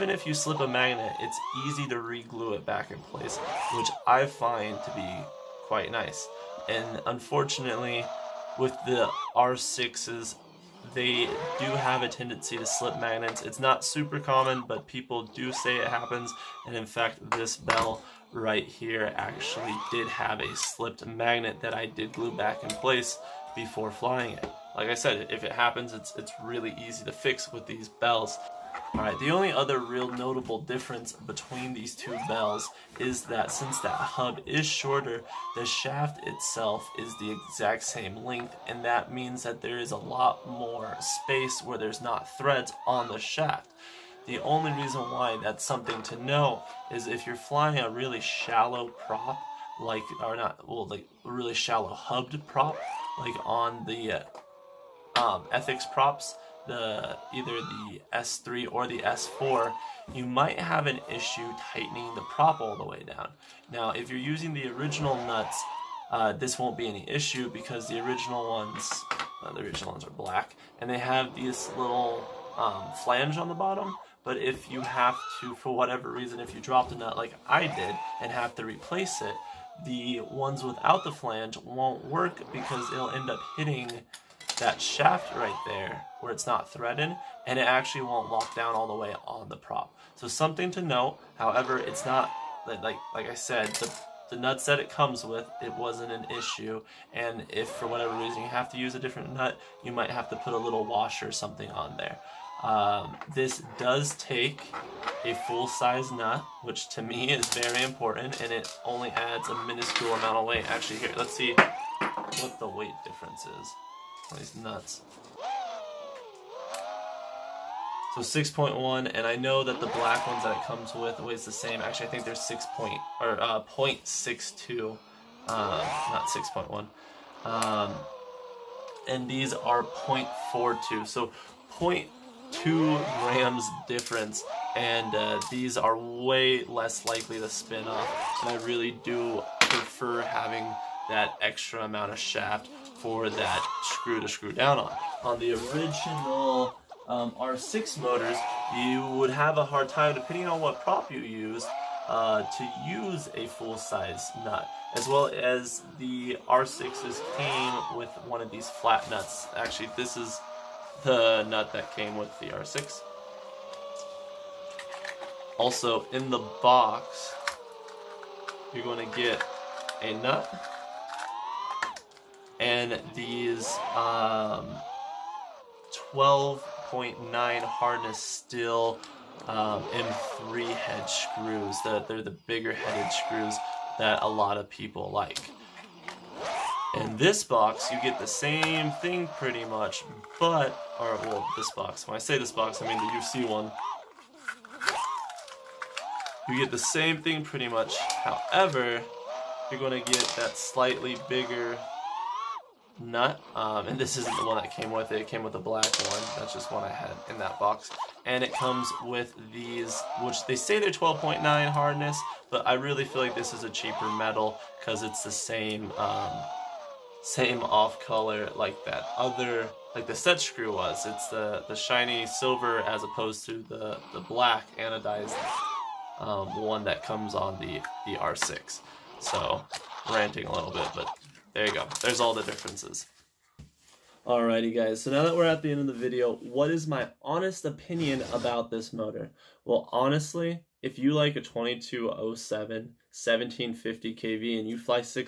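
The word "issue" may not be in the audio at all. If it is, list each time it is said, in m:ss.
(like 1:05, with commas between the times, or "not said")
1:01, 1:07, 1:36.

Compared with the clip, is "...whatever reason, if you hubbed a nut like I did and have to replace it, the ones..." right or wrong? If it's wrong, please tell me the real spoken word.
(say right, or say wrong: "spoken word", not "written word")
wrong: "dropped", not "hubbed".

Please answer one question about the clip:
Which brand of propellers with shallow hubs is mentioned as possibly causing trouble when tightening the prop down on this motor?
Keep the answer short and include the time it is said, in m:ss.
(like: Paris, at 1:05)
Ethix, at 0:55.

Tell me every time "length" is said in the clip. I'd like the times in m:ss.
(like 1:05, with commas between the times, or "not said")
0:38.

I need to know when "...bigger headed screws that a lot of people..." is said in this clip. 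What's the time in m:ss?
3:02.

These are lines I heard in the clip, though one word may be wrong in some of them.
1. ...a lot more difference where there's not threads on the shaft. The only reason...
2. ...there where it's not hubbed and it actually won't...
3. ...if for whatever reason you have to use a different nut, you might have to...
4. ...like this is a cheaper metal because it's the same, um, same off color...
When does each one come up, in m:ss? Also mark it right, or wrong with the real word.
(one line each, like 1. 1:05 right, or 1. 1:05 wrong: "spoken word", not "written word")
1. 0:39 wrong: "space", not "difference"
2. 1:25 wrong: "threaded", not "hubbed"
3. 1:37 right
4. 3:33 right.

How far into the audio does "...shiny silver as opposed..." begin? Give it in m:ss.
3:41.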